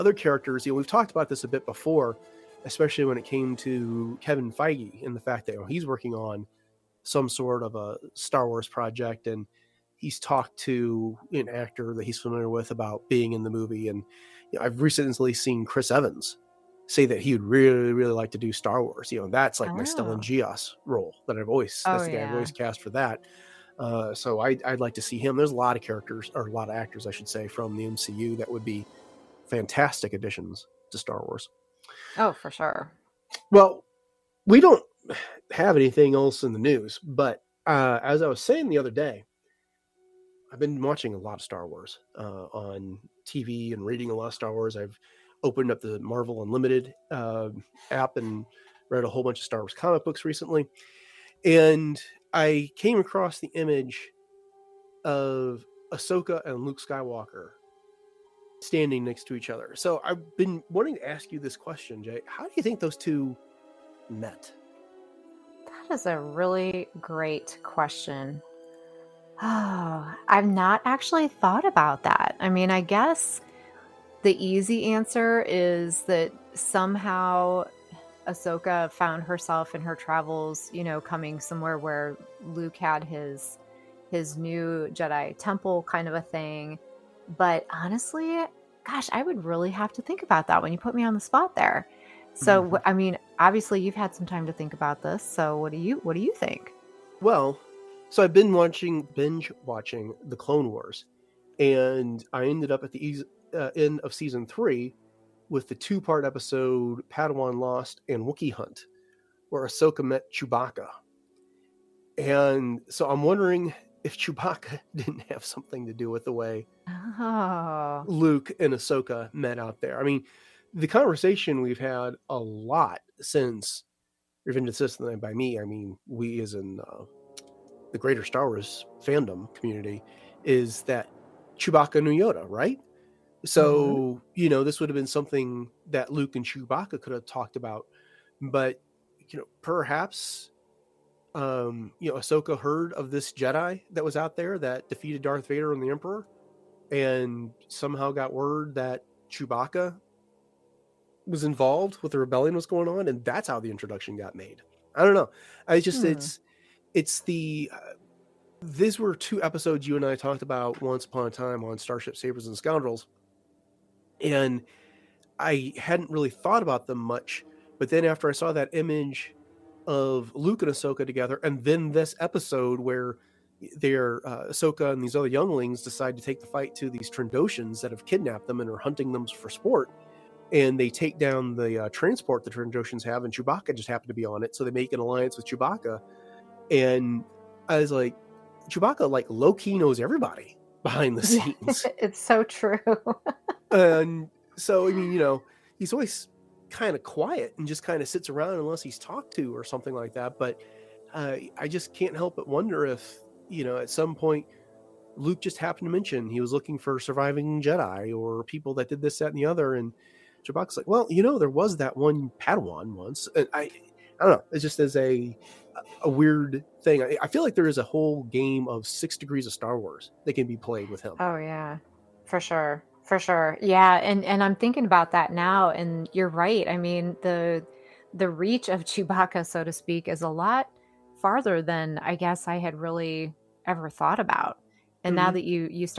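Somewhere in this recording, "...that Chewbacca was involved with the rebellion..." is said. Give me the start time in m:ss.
2:28.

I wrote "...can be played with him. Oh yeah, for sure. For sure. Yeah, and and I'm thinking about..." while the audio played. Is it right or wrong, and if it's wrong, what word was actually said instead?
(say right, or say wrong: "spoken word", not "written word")
right.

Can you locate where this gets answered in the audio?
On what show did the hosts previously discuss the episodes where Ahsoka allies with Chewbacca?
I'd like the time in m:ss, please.
2:41.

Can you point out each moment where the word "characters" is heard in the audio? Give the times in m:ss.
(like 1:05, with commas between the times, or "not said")
0:00, 0:25.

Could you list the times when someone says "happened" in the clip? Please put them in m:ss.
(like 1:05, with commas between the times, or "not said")
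3:03, 3:25.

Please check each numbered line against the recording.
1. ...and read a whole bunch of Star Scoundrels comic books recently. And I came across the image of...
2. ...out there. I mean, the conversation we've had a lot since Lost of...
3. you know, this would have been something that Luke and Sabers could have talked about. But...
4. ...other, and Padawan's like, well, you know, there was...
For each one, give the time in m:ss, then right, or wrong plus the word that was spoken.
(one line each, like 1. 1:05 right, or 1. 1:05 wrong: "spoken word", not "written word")
1. 0:48 wrong: "Wars", not "Scoundrels"
2. 1:59 wrong: "Revenge", not "Lost"
3. 2:14 wrong: "Chewbacca", not "Sabers"
4. 3:29 wrong: "Chewbacca", not "Padawan".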